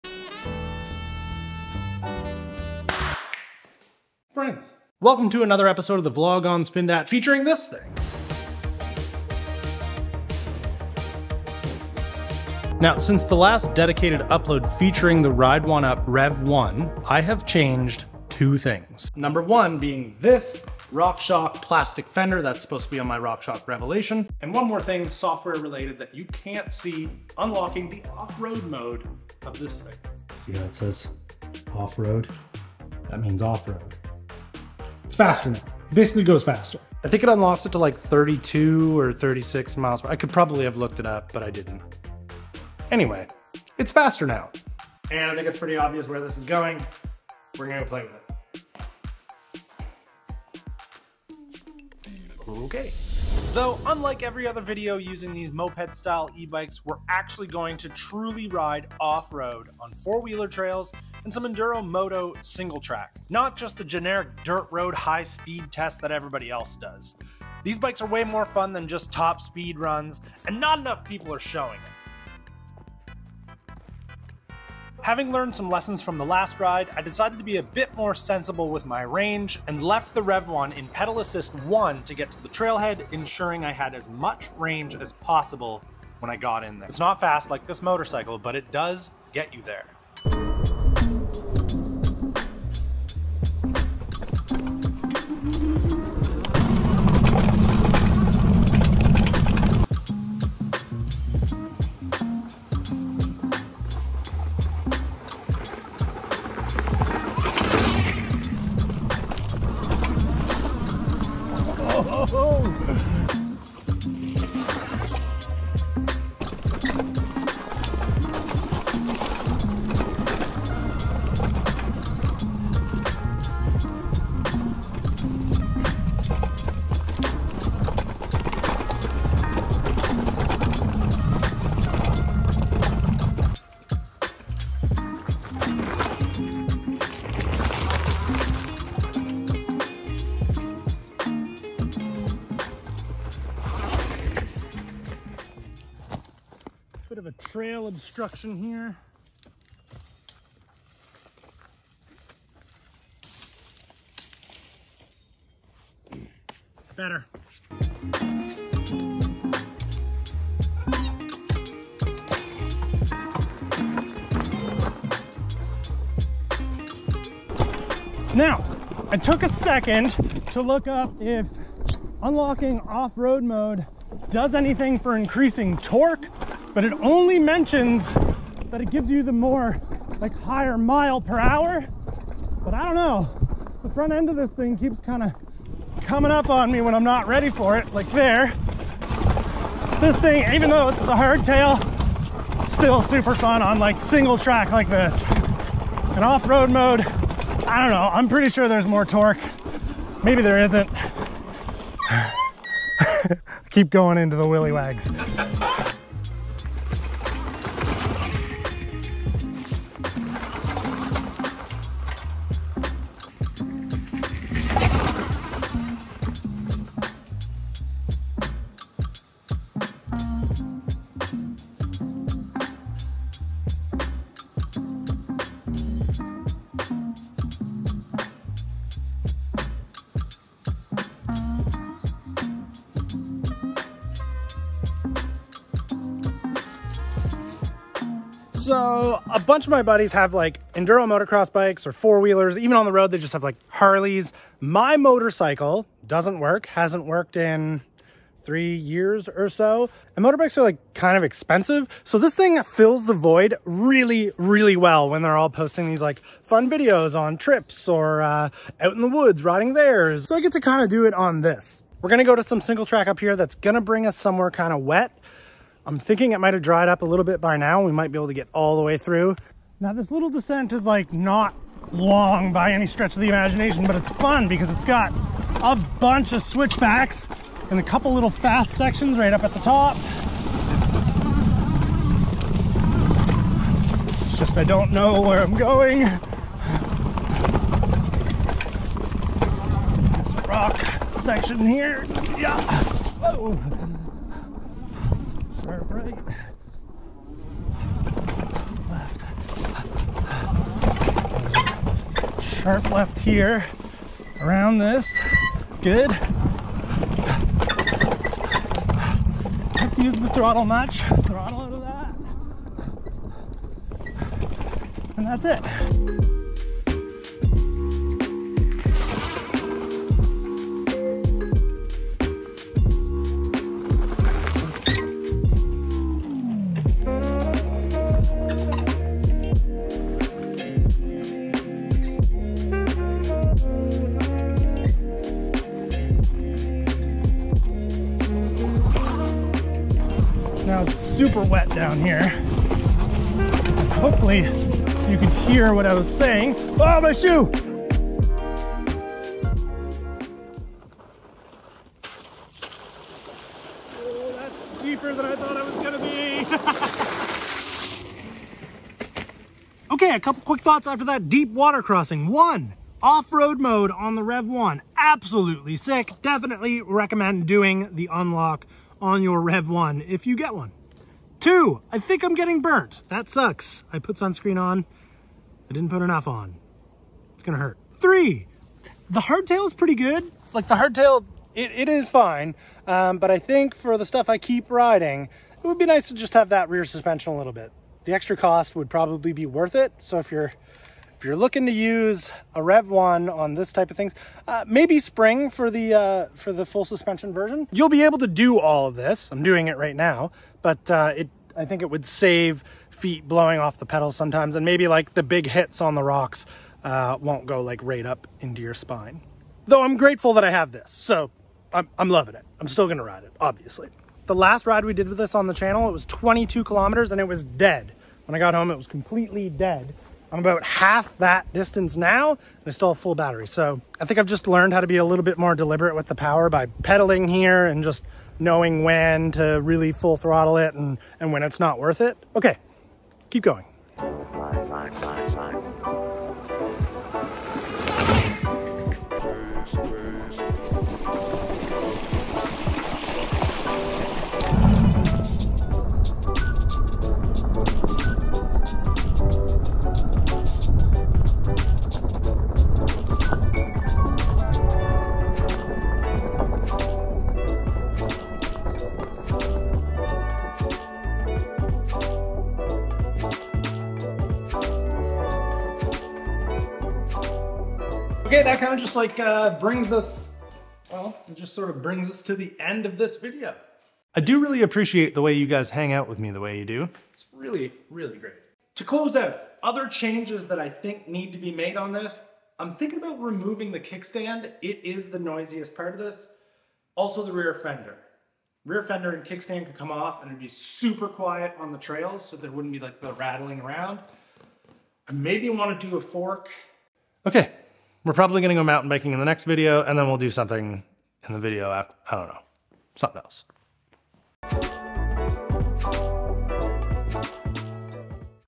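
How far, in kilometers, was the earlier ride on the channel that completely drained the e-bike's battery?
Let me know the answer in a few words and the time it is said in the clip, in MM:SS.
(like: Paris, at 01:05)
22 kilometers, at 06:56.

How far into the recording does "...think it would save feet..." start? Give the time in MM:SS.
06:41.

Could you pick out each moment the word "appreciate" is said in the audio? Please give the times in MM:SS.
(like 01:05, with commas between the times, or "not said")
07:54.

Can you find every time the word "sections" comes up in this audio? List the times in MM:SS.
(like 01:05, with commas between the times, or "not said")
04:38, 04:51.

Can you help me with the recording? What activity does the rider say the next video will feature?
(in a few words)
mountain biking.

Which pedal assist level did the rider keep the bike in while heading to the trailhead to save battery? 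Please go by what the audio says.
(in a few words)
pedal assist 1.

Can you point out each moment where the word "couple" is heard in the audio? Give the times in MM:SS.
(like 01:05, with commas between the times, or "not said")
04:37, 06:00.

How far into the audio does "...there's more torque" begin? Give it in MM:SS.
03:18.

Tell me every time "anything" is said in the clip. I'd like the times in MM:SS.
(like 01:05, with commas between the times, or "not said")
02:54.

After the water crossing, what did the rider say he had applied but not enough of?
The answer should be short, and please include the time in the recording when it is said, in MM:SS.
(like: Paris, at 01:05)
sunscreen, at 06:14.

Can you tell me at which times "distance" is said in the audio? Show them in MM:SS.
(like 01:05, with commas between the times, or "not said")
07:01.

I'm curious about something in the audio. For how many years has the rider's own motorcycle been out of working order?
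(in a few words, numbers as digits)
3.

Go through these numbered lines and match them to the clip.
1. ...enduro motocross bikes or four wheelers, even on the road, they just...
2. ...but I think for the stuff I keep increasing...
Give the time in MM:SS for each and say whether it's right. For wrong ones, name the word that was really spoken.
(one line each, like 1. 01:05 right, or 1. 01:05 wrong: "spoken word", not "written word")
1. 04:00 right
2. 06:23 wrong: "riding", not "increasing".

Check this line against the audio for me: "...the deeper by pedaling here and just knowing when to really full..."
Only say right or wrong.
wrong.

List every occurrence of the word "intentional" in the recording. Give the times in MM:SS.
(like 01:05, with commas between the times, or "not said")
not said.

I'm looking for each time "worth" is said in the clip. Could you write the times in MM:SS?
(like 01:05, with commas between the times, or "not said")
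06:29, 07:11.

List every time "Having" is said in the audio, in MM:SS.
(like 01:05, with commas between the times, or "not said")
01:15.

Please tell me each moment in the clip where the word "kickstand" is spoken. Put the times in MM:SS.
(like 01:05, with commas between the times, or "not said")
08:03, 08:09.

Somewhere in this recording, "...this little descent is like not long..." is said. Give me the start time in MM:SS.
04:29.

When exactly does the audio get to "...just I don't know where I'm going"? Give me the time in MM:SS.
04:44.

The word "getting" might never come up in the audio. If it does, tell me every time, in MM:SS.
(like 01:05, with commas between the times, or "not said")
06:12.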